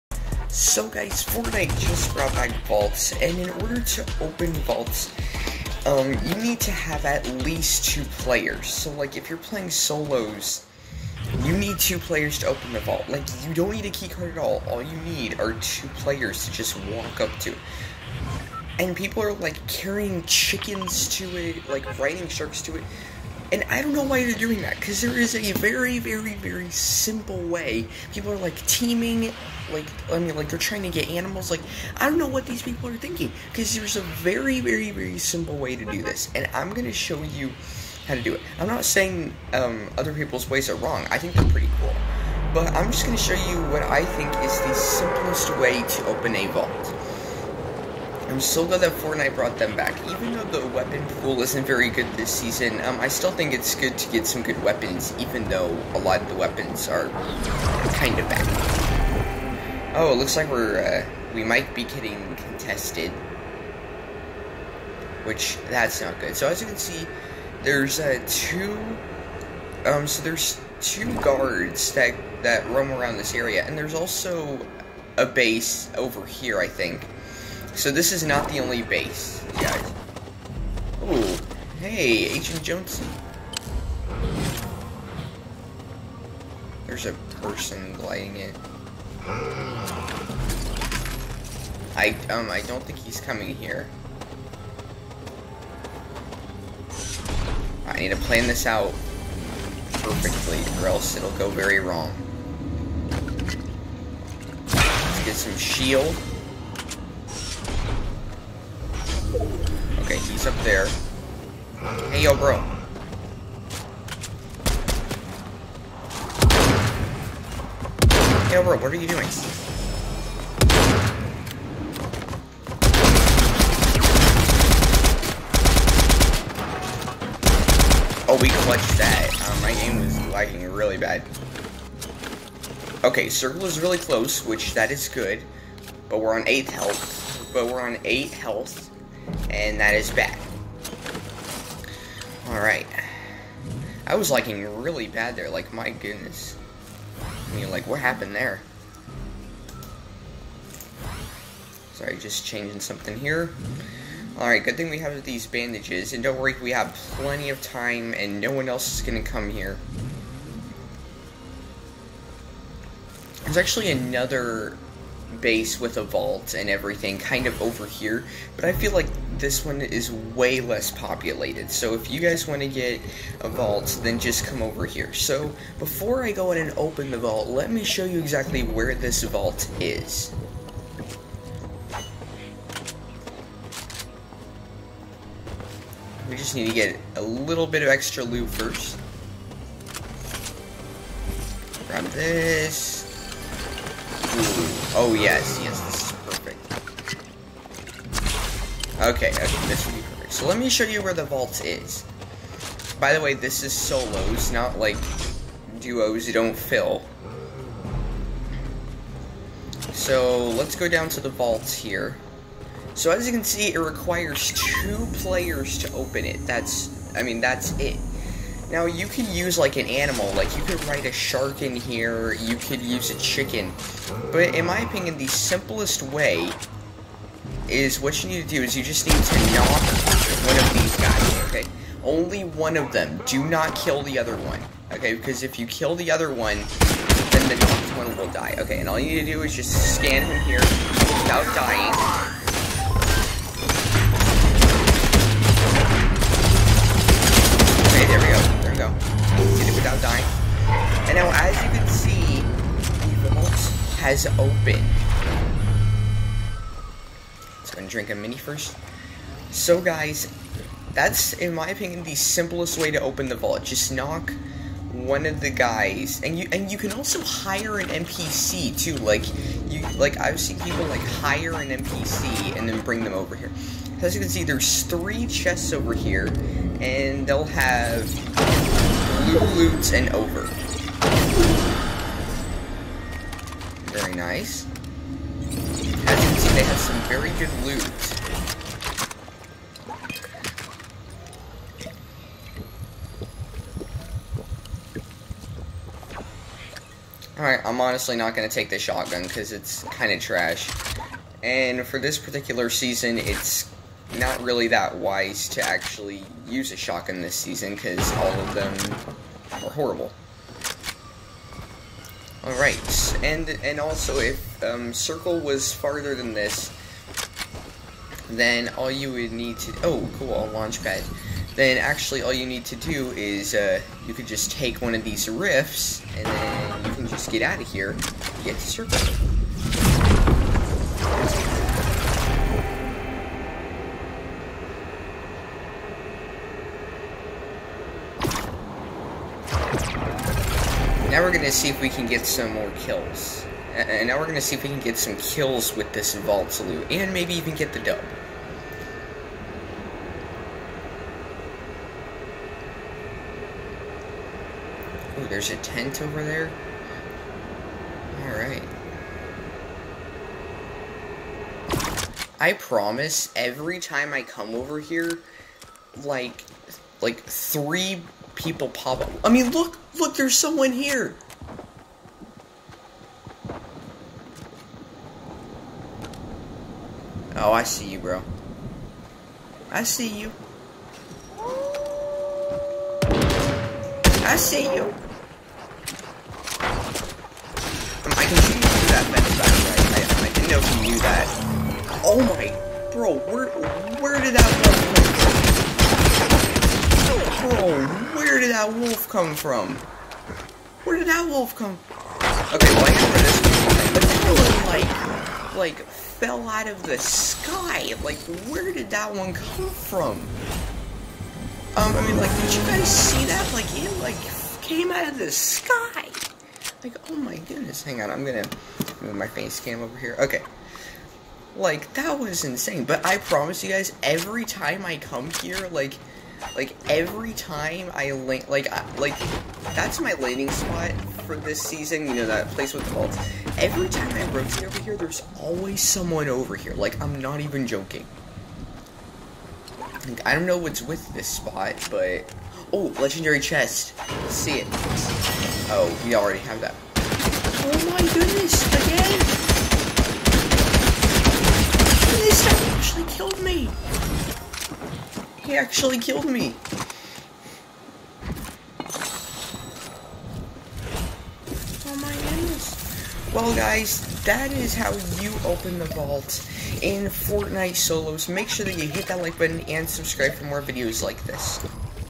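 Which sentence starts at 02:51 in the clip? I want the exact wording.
So if you guys want to get a vault, then just come over here.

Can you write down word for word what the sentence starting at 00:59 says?
Oh, it looks like we're, uh, we might be getting contested.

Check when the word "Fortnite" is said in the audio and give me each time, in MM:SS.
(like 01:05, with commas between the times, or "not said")
00:01, 00:48, 07:47.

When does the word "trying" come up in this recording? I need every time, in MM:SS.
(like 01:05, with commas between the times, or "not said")
00:30.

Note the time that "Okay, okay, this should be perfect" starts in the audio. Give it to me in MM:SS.
03:19.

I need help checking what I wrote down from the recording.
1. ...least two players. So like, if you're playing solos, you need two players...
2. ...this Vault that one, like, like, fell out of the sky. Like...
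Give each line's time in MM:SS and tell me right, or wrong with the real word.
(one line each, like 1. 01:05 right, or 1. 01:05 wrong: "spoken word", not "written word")
1. 00:07 right
2. 06:43 wrong: "But", not "Vault".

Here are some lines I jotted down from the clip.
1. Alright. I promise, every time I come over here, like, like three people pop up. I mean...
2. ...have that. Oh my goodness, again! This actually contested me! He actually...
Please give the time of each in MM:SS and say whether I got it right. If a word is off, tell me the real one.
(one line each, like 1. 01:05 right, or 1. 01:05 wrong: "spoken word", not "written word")
1. 05:58 right
2. 07:26 wrong: "killed", not "contested".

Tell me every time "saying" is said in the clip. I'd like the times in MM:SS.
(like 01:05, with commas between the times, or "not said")
00:38.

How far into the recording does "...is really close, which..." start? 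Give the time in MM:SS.
02:13.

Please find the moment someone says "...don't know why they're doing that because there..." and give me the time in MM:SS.
00:23.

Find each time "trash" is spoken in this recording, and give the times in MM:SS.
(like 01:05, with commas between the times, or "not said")
05:00.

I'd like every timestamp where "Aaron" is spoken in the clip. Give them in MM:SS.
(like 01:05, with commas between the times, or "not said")
not said.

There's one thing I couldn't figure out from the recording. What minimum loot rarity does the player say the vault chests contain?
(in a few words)
Blue.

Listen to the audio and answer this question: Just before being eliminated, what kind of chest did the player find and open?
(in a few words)
Legendary chest.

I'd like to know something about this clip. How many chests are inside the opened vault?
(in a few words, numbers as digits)
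3.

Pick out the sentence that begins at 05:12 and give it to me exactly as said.
Alright, and and also if um, circle was farther than this, then all you would need to- oh, cool, launch pad.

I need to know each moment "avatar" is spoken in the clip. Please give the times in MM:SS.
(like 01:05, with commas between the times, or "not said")
not said.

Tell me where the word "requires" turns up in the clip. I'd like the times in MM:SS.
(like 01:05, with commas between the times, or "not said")
03:33.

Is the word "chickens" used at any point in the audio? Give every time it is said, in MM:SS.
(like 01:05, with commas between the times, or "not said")
00:20, 03:43.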